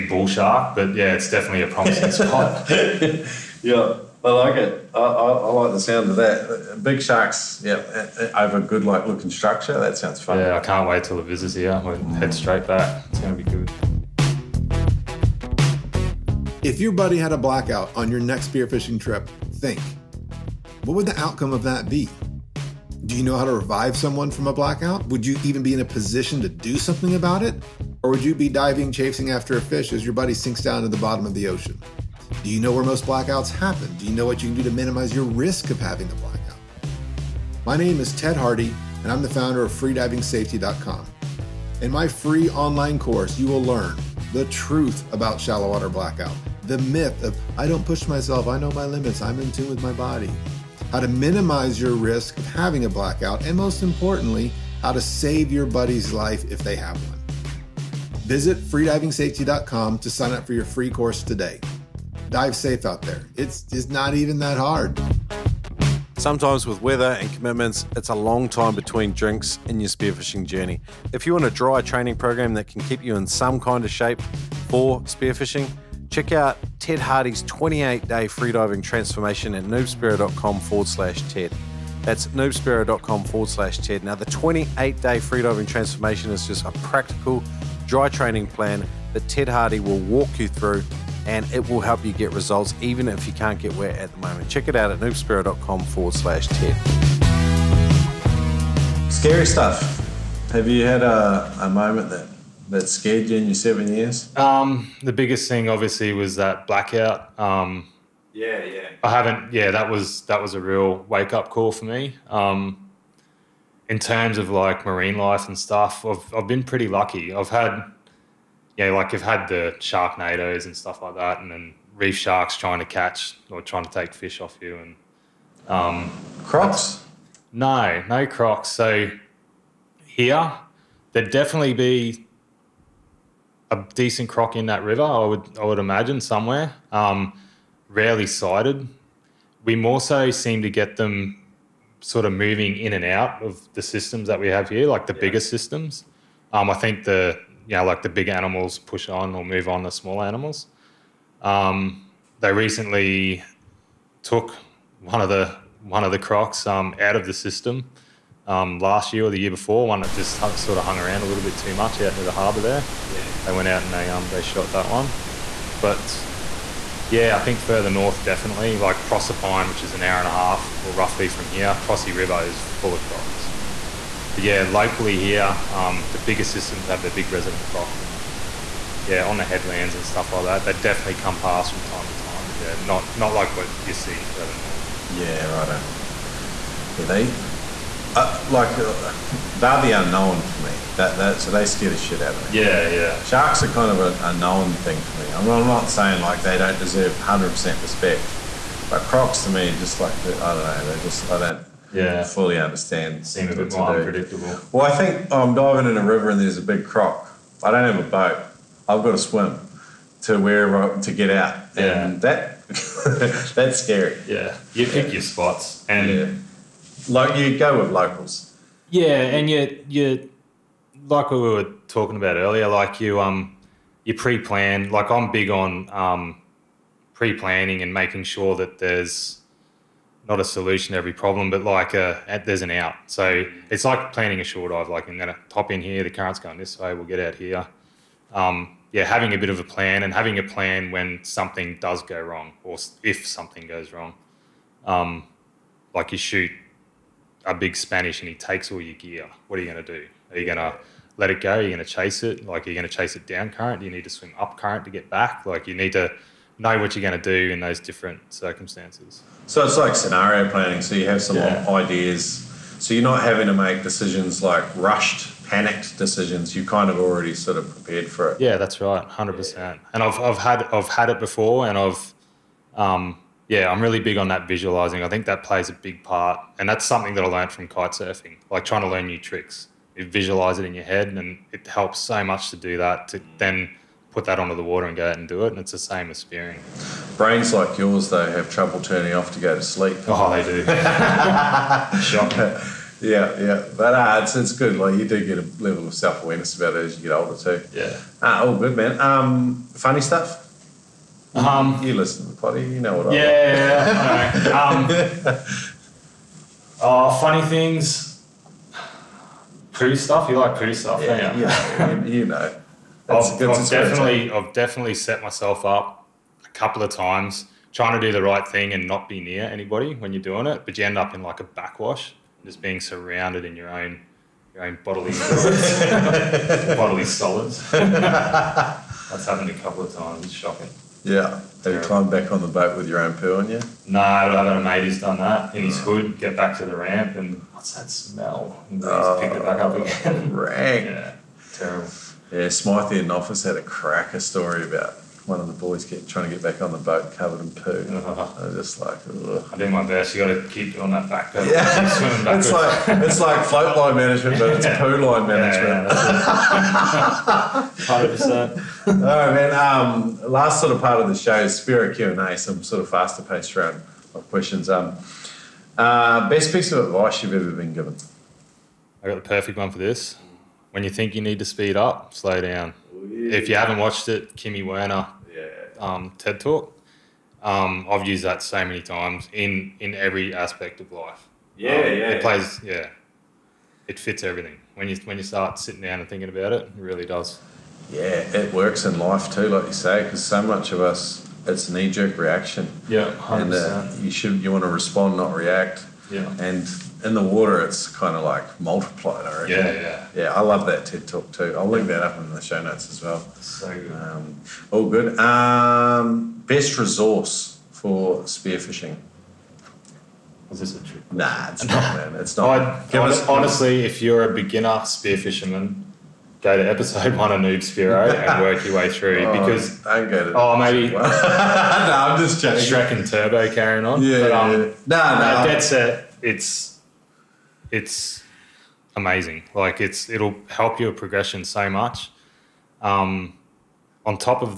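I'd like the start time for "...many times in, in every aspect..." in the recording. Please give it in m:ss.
6:18.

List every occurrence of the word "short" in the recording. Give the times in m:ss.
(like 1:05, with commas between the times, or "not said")
3:54.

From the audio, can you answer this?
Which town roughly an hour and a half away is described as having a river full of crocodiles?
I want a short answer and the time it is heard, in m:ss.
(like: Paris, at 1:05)
Proserpine, at 2:49.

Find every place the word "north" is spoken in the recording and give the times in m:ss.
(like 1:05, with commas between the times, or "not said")
2:47, 3:04.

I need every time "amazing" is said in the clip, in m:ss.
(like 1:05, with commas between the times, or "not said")
7:08.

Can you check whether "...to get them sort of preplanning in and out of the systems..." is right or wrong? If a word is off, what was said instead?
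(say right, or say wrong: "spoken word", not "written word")
wrong: "moving", not "preplanning".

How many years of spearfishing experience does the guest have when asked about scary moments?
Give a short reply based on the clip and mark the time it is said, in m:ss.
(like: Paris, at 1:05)
7, at 1:43.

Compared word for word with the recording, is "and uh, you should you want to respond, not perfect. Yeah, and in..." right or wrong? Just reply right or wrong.
wrong.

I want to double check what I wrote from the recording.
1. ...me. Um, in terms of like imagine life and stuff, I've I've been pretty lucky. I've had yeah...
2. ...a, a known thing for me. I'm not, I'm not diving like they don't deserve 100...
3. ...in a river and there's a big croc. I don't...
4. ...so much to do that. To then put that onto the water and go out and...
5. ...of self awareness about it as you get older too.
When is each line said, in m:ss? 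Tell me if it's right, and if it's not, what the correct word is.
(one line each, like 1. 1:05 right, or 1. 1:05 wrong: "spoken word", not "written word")
1. 1:51 wrong: "marine", not "imagine"
2. 3:13 wrong: "saying", not "diving"
3. 3:25 right
4. 4:41 right
5. 4:55 right.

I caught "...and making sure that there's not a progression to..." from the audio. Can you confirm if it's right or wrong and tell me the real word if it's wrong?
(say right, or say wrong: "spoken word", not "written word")
wrong: "solution", not "progression".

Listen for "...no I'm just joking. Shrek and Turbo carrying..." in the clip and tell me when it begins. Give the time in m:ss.
7:00.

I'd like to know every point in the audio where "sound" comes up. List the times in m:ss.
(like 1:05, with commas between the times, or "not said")
0:05, 0:09.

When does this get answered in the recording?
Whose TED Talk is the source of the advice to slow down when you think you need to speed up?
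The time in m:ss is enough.
6:14.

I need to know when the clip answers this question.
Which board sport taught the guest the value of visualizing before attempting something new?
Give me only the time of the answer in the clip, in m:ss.
4:37.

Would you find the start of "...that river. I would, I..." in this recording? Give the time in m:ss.
2:14.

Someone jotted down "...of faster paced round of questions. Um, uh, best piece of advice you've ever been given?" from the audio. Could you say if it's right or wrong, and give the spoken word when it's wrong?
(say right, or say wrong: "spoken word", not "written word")
right.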